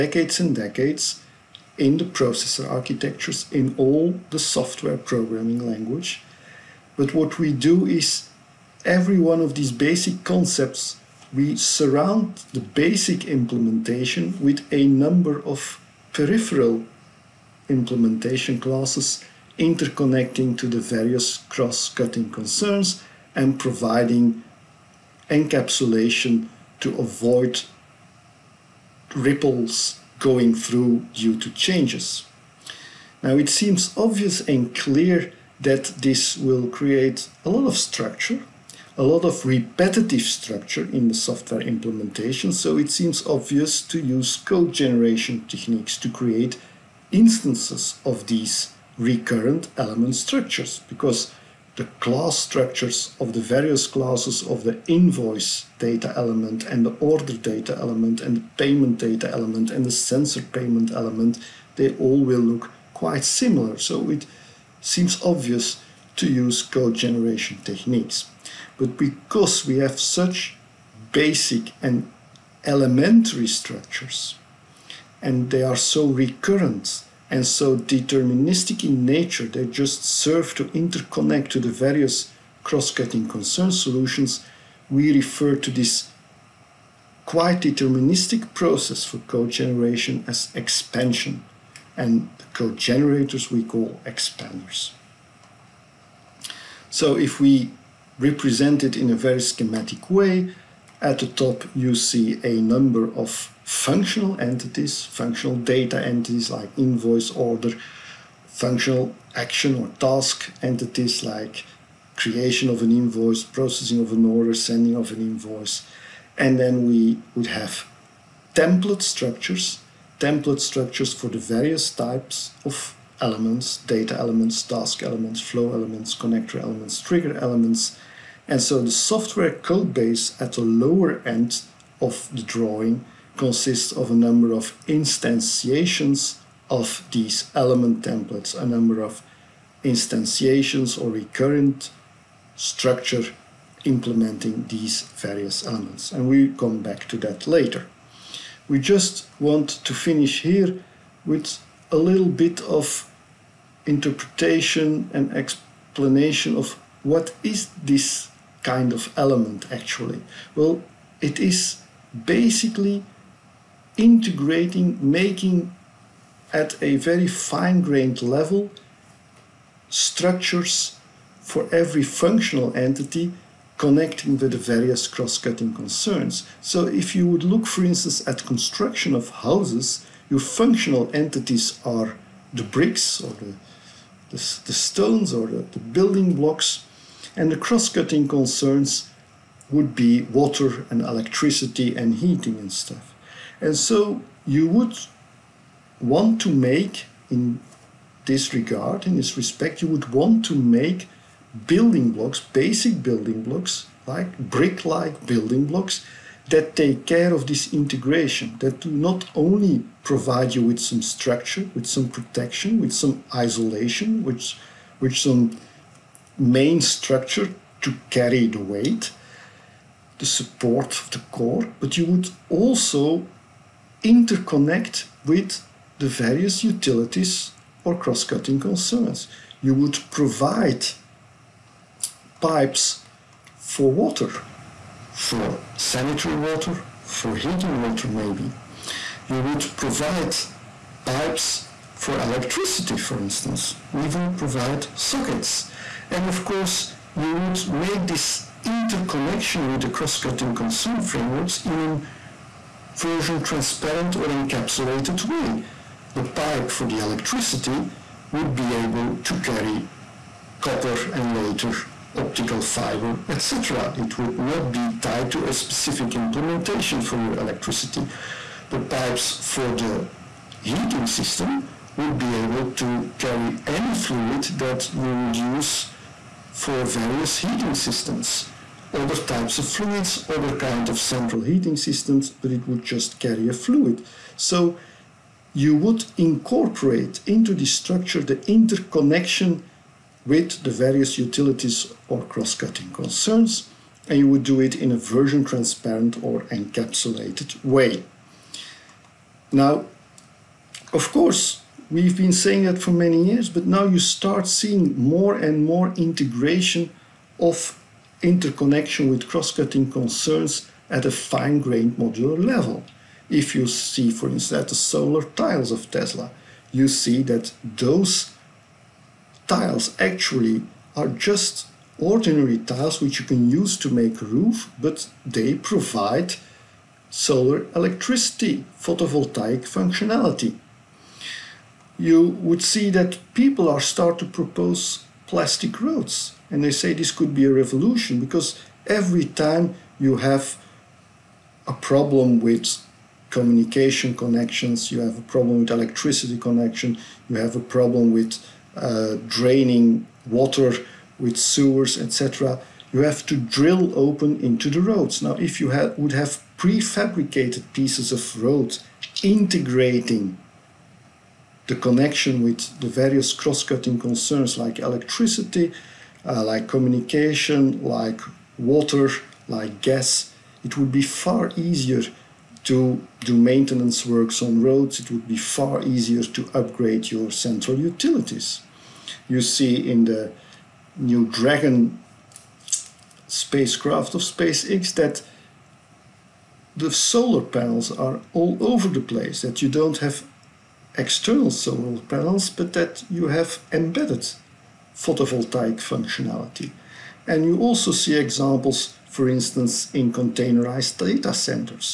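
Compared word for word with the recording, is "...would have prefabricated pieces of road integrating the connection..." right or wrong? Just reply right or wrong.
right.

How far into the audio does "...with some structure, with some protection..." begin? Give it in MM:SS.
03:30.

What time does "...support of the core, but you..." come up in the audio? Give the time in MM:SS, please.
03:40.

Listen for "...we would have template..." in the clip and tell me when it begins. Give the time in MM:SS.
01:56.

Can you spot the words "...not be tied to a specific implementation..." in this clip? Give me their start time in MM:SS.
04:24.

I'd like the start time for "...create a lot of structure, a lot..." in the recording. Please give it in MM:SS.
00:36.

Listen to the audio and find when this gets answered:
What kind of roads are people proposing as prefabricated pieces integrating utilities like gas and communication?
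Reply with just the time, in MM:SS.
05:35.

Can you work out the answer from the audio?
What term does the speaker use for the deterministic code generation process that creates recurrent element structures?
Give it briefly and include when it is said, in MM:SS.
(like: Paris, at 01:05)
Expansion, at 01:30.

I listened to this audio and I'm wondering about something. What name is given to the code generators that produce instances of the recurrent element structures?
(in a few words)
Expanders.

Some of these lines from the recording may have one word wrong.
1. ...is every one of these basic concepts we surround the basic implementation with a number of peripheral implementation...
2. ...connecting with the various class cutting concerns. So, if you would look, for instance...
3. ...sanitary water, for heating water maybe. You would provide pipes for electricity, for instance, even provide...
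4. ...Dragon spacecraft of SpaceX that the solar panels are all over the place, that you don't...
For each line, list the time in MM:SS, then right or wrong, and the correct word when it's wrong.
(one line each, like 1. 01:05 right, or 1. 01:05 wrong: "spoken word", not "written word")
1. 00:07 right
2. 02:53 wrong: "cross", not "class"
3. 03:55 right
4. 06:21 right.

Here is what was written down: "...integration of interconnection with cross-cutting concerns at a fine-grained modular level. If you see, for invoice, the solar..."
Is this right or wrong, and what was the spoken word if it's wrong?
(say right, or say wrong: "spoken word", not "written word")
wrong: "instance", not "invoice".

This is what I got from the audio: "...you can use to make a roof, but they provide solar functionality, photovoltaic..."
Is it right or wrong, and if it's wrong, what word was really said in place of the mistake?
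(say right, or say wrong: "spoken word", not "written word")
wrong: "electricity", not "functionality".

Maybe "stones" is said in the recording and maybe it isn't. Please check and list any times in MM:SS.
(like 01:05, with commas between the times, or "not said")
03:04.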